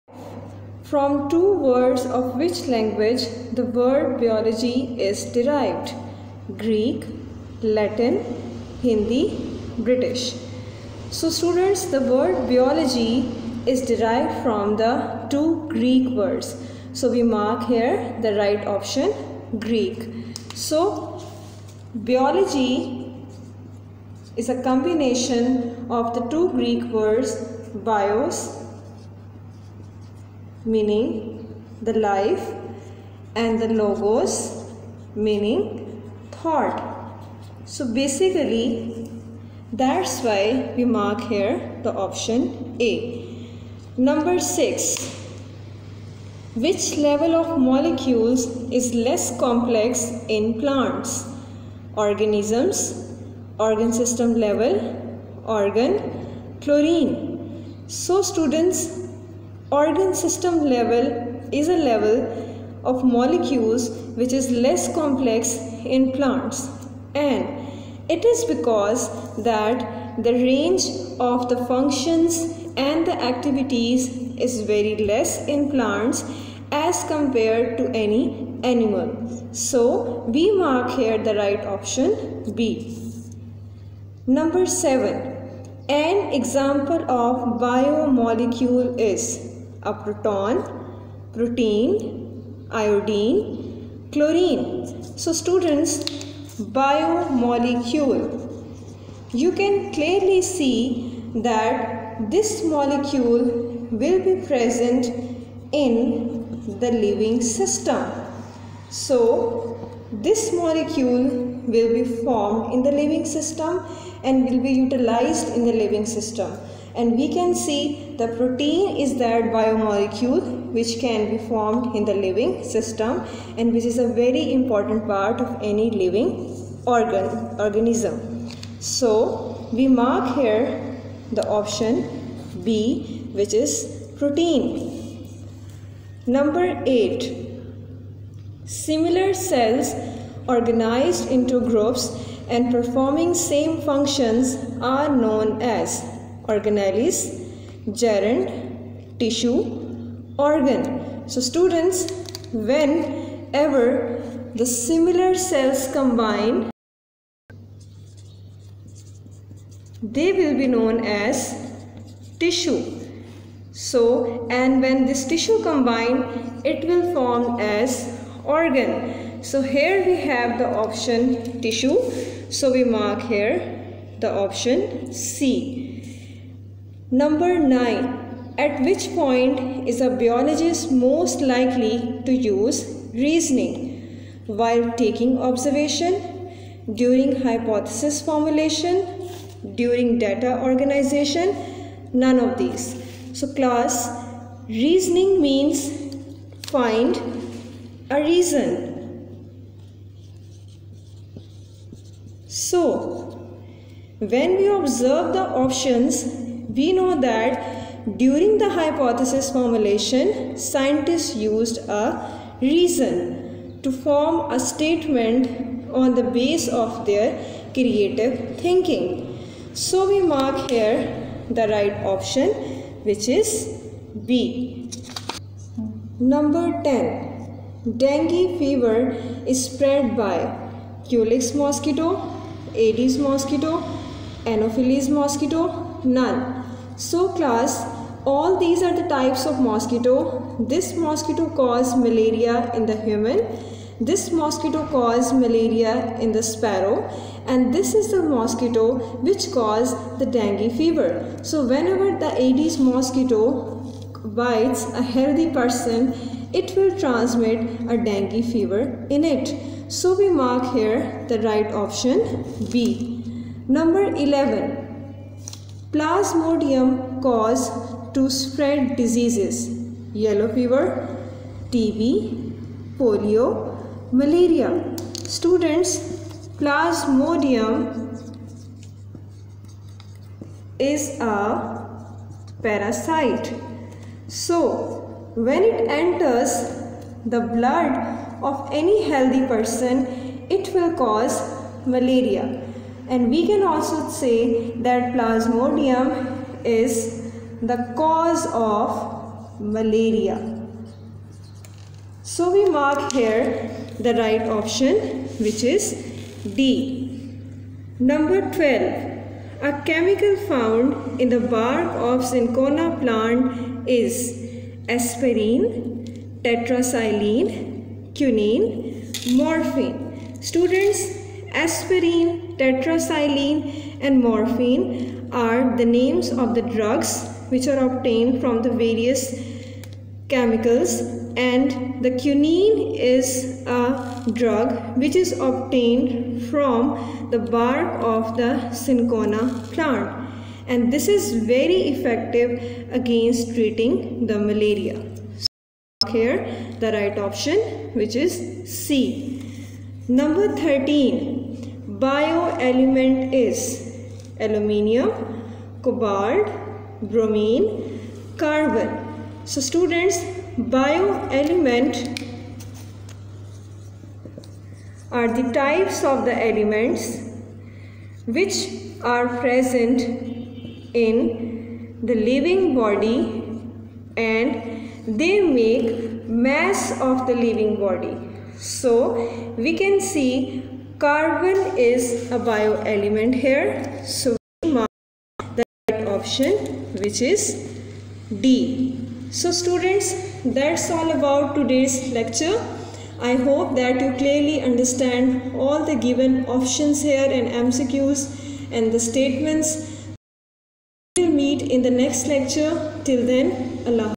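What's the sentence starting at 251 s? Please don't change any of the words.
So whenever the Aedes mosquito bites a healthy person, it will transmit a dengue fever in it.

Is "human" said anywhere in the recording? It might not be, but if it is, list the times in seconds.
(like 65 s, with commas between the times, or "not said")
243 s.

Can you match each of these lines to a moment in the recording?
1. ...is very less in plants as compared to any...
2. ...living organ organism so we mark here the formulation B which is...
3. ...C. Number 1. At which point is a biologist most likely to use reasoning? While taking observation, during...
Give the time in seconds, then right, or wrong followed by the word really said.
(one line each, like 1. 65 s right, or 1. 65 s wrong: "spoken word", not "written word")
1. 74 s right
2. 125 s wrong: "option", not "formulation"
3. 175 s wrong: "9", not "1".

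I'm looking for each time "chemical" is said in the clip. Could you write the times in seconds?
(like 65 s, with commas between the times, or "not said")
309 s, 330 s.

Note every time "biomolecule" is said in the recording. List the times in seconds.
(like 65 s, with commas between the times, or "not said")
87 s, 96 s, 119 s.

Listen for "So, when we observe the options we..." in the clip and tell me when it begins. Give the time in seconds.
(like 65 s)
202 s.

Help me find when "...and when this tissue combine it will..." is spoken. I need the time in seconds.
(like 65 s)
164 s.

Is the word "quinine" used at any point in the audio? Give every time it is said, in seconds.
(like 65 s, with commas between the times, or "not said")
318 s, 332 s.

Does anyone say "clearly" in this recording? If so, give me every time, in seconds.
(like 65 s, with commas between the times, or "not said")
99 s, 394 s.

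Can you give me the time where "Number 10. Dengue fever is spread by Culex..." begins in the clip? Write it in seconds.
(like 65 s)
226 s.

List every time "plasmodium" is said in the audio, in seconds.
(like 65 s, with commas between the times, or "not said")
265 s, 276 s, 295 s.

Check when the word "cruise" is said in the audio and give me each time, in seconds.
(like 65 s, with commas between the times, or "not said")
not said.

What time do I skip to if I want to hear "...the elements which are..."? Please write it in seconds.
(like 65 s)
366 s.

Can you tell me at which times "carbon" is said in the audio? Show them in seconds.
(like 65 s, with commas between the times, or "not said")
358 s, 381 s.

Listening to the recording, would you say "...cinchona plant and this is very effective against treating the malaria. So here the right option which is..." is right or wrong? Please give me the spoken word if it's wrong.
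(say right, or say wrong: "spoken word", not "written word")
right.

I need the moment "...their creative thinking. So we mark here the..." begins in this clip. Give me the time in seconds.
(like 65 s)
217 s.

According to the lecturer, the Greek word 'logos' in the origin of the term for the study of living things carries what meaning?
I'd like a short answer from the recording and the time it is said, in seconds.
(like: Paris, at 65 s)
thought, at 36 s.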